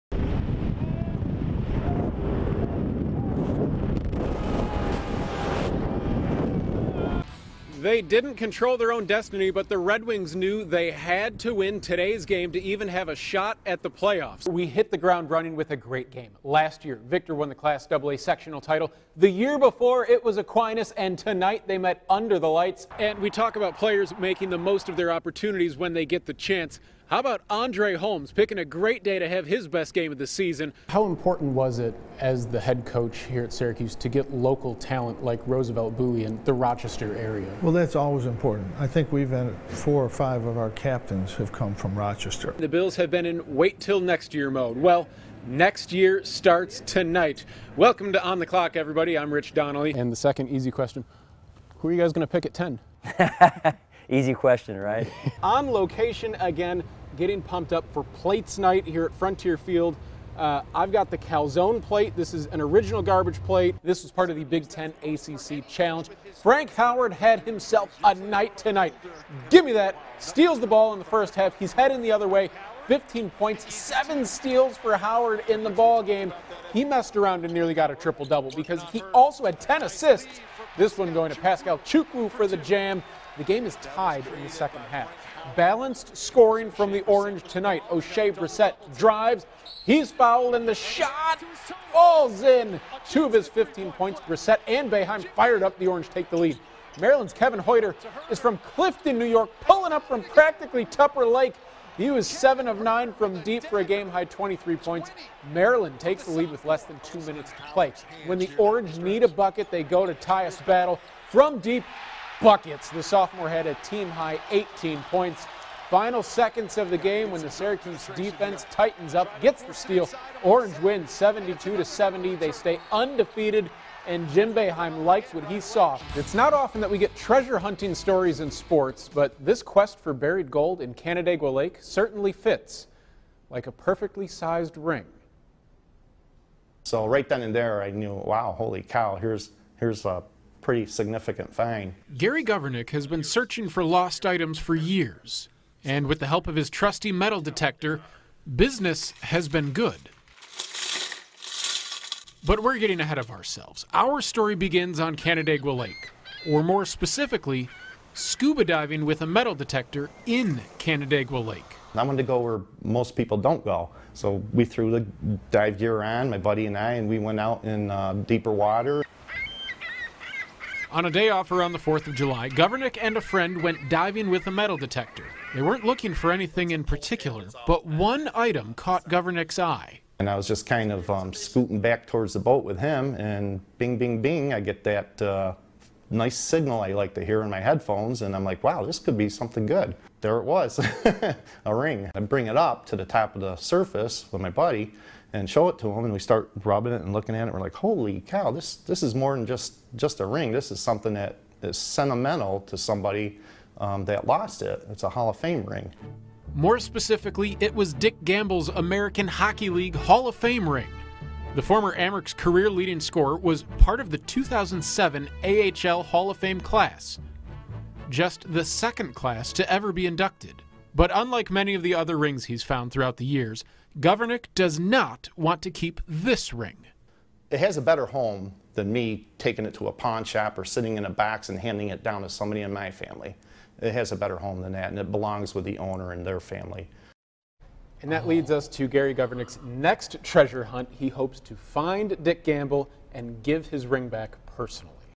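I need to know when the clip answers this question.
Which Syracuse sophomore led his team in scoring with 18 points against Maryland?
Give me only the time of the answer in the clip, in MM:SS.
01:50.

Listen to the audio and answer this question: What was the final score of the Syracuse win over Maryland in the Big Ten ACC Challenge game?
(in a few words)
72 to 70.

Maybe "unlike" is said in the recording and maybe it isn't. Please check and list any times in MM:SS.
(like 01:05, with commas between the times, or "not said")
03:41.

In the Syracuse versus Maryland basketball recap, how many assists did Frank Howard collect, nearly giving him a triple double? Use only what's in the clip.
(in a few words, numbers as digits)
10.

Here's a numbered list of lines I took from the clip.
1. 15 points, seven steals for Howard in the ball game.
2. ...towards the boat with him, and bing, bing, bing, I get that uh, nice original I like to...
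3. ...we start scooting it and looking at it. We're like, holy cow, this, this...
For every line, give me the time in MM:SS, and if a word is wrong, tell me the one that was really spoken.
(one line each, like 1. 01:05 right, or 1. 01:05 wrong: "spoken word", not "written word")
1. 01:12 right
2. 03:02 wrong: "signal", not "original"
3. 03:16 wrong: "rubbing", not "scooting".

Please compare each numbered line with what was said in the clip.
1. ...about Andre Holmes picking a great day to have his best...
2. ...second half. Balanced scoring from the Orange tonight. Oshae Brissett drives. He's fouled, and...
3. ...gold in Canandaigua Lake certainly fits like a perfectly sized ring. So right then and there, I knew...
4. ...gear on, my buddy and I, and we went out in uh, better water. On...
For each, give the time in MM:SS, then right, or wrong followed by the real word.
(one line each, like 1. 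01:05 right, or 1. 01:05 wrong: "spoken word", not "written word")
1. 00:27 right
2. 01:24 right
3. 02:10 right
4. 02:45 wrong: "deeper", not "better".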